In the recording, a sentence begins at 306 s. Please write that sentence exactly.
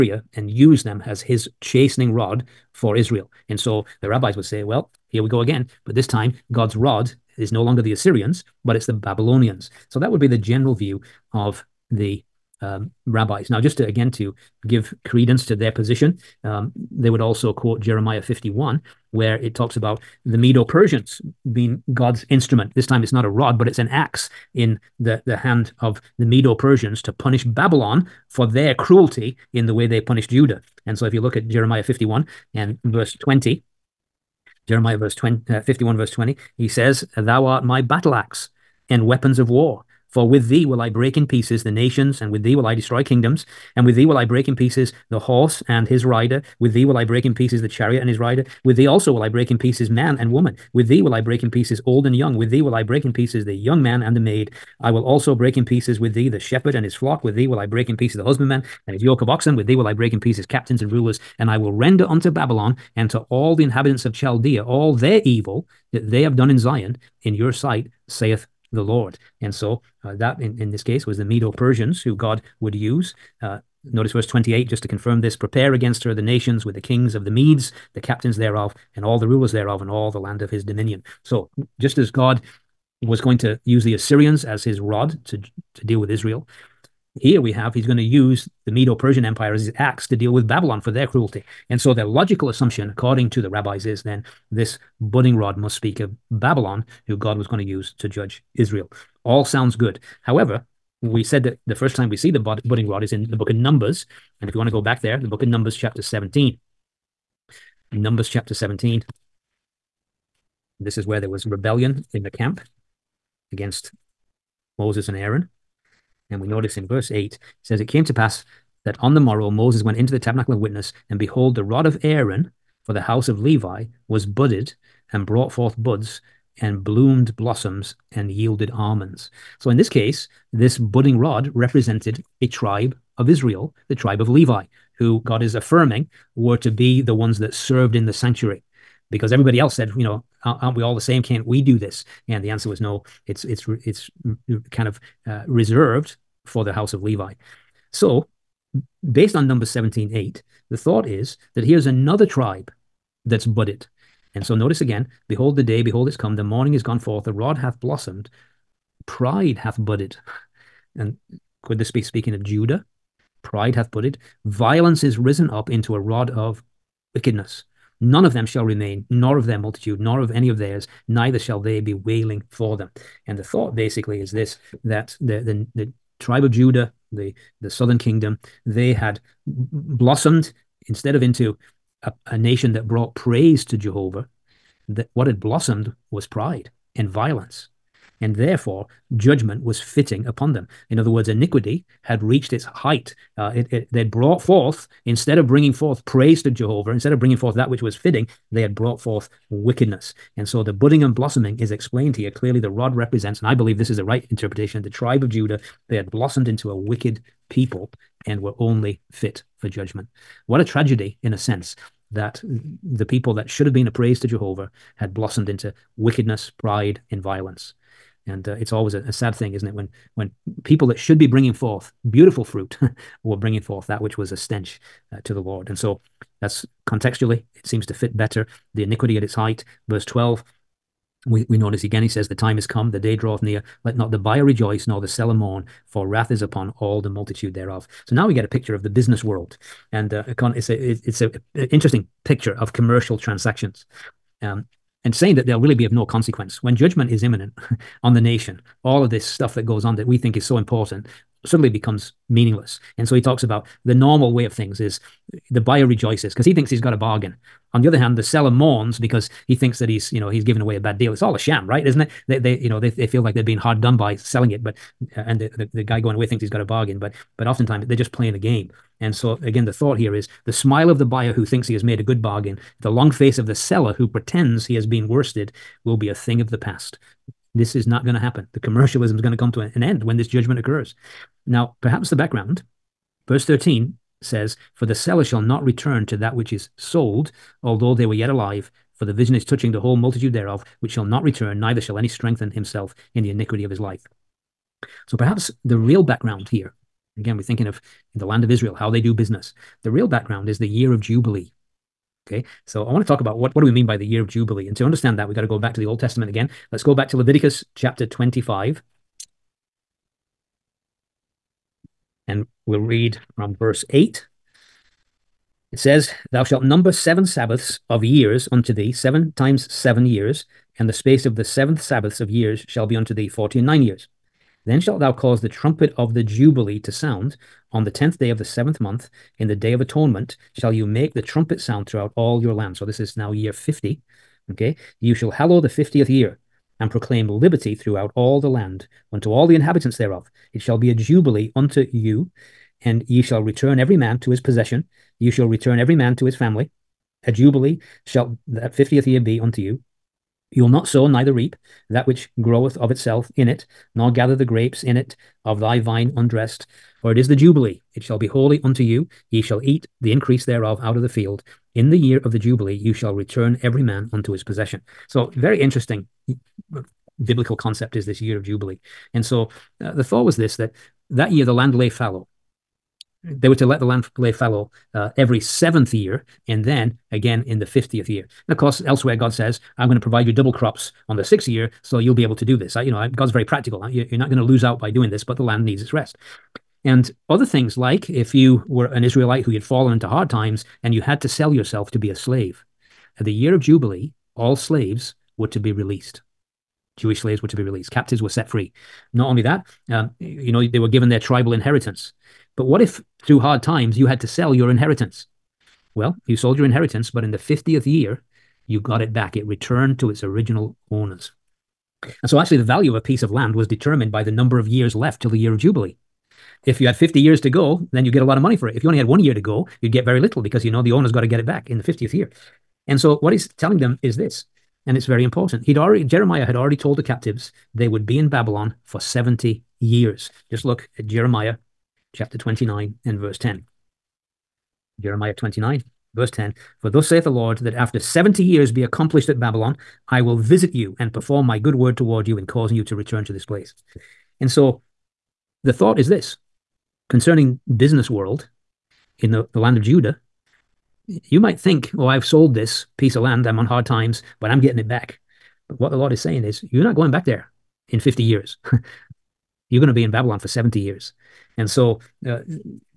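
Let's go back to Leviticus chapter 25.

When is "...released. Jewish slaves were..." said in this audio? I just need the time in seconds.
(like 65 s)
395 s.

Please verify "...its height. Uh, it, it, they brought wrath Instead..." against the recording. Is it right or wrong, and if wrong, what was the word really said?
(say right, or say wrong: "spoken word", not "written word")
wrong: "forth", not "wrath".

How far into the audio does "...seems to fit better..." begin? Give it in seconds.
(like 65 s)
227 s.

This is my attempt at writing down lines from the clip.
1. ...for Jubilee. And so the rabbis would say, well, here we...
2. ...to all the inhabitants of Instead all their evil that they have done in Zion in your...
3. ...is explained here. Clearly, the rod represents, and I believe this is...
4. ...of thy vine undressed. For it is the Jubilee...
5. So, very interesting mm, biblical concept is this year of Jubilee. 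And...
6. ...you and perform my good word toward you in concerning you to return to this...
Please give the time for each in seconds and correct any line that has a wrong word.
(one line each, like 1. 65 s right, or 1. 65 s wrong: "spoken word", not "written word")
1. 2 s wrong: "Israel", not "Jubilee"
2. 63 s wrong: "Chaldea", not "Instead"
3. 201 s right
4. 355 s right
5. 365 s right
6. 440 s wrong: "causing", not "concerning".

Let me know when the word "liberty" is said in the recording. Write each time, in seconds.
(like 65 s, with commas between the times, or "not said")
337 s.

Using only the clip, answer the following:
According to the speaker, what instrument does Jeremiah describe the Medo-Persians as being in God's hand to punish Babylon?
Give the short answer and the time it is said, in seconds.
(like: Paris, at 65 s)
an axe, at 23 s.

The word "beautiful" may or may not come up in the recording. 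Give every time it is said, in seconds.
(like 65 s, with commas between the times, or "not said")
222 s.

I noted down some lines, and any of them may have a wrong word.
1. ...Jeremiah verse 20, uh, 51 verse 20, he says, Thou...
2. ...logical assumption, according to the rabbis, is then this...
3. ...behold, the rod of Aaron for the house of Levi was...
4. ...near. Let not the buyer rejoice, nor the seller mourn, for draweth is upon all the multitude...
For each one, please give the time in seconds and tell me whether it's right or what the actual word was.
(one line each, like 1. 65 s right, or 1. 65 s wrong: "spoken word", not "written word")
1. 34 s right
2. 92 s right
3. 121 s right
4. 233 s wrong: "wrath", not "draweth".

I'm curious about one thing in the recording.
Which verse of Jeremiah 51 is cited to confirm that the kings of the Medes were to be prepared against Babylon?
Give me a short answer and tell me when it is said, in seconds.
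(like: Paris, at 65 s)
28, at 74 s.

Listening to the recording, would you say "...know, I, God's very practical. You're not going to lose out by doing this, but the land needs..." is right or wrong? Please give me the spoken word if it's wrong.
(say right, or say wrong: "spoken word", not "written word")
right.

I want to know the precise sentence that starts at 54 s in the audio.
I will also break in pieces with thee the shepherd and his flock.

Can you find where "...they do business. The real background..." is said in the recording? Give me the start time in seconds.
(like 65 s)
298 s.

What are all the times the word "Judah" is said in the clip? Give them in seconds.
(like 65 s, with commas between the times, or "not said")
30 s, 162 s, 176 s, 205 s, 449 s.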